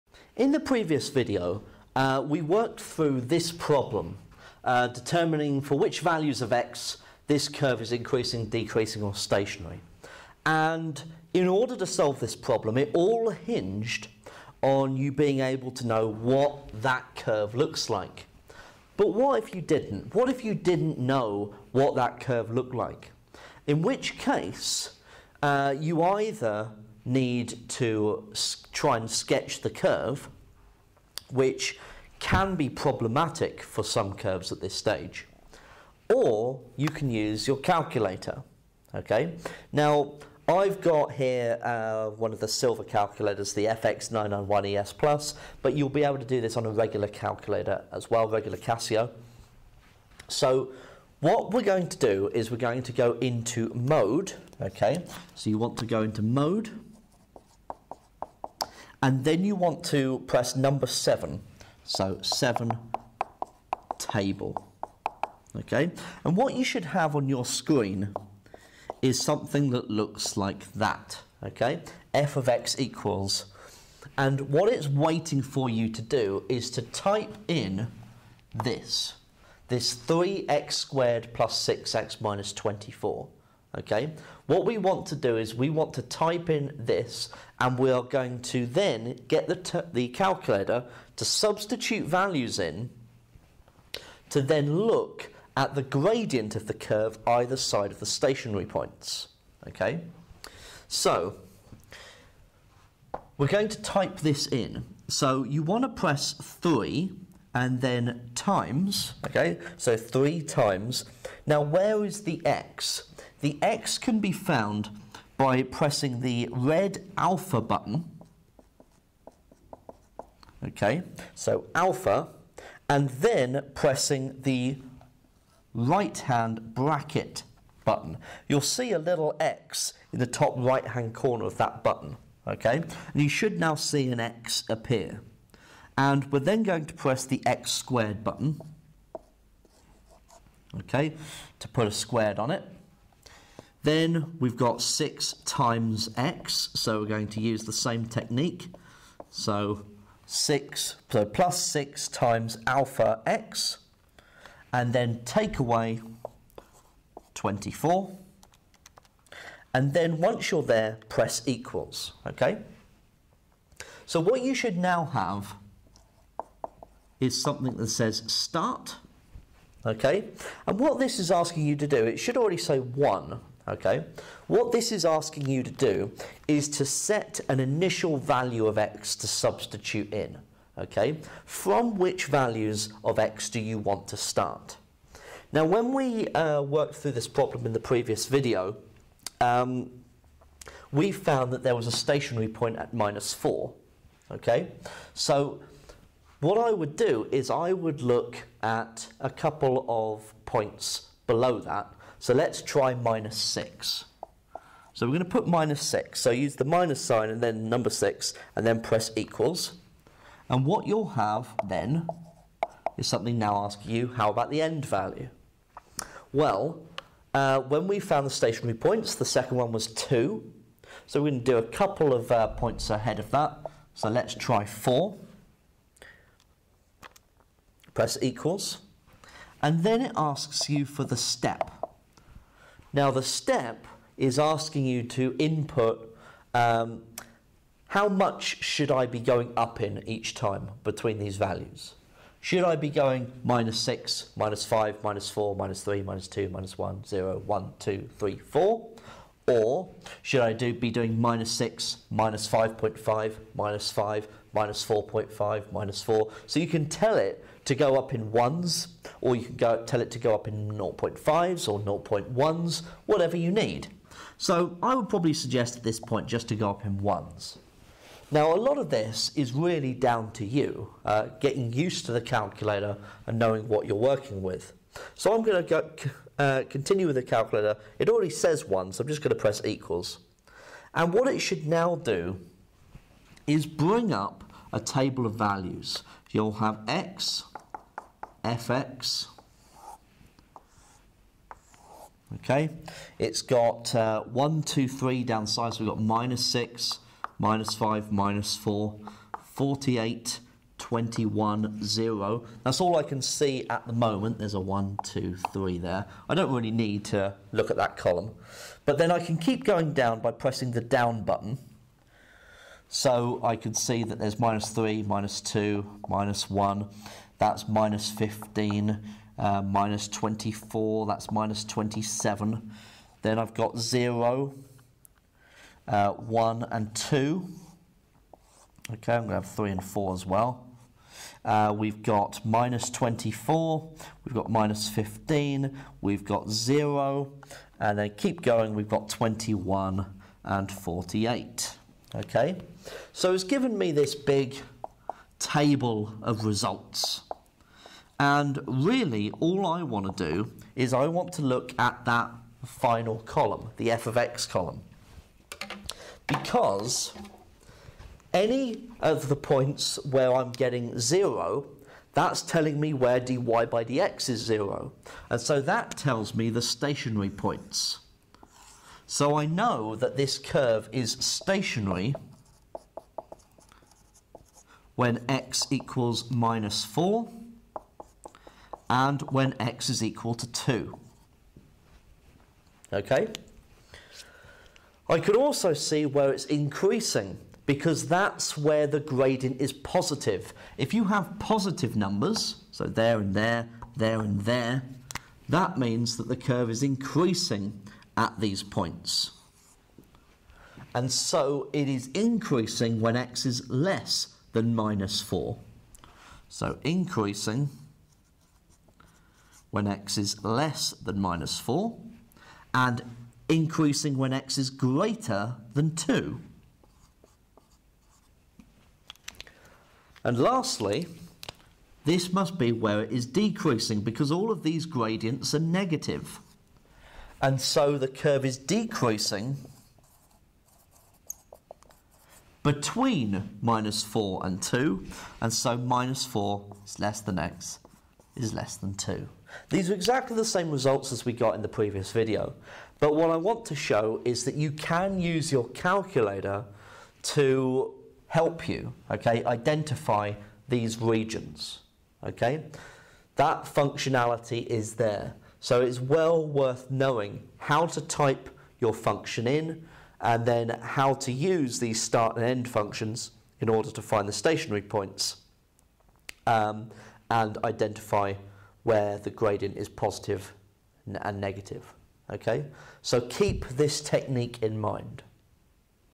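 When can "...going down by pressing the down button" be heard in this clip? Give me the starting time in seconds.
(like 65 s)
309 s.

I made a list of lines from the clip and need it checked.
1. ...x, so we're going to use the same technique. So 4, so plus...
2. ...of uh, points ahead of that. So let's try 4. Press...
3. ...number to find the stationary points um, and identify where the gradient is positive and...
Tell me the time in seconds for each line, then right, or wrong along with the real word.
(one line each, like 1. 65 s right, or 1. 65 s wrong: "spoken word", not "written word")
1. 146 s wrong: "6", not "4"
2. 222 s right
3. 463 s wrong: "order", not "number".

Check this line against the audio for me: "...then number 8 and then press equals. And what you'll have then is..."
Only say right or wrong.
wrong.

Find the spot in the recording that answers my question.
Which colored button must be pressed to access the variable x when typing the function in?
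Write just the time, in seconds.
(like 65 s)
116 s.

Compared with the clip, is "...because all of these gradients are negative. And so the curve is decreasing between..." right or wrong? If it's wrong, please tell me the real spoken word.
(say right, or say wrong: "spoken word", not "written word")
right.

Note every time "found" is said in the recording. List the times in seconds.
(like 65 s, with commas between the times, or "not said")
114 s, 191 s, 217 s.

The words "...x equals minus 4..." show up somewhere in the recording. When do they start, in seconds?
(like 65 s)
375 s.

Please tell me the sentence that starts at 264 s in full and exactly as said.
So I would probably suggest at this point just to go up in ones.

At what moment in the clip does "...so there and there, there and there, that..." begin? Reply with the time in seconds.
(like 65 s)
392 s.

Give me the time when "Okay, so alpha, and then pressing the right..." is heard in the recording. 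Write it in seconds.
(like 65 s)
120 s.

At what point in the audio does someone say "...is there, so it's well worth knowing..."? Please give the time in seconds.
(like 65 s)
454 s.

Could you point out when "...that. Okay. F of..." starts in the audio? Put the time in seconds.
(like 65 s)
70 s.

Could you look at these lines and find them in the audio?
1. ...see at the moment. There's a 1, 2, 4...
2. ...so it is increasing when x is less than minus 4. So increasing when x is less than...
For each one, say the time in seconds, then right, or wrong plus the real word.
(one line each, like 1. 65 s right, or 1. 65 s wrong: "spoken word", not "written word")
1. 303 s wrong: "3", not "4"
2. 401 s right.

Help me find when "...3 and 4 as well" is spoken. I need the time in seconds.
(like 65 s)
329 s.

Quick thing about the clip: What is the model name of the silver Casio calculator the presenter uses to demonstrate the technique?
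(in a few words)
FX991ES Plus.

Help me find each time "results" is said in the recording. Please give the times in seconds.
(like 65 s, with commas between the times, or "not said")
346 s, 440 s.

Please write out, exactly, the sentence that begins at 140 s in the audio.
Okay, to put a squared on it.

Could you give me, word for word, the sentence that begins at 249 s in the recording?
Or should I do, be doing minus 6, minus 5.5, minus 5, minus 4.5, minus 4?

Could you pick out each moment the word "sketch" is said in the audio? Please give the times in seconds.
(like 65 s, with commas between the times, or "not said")
29 s.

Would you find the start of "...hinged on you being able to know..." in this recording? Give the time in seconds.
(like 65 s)
13 s.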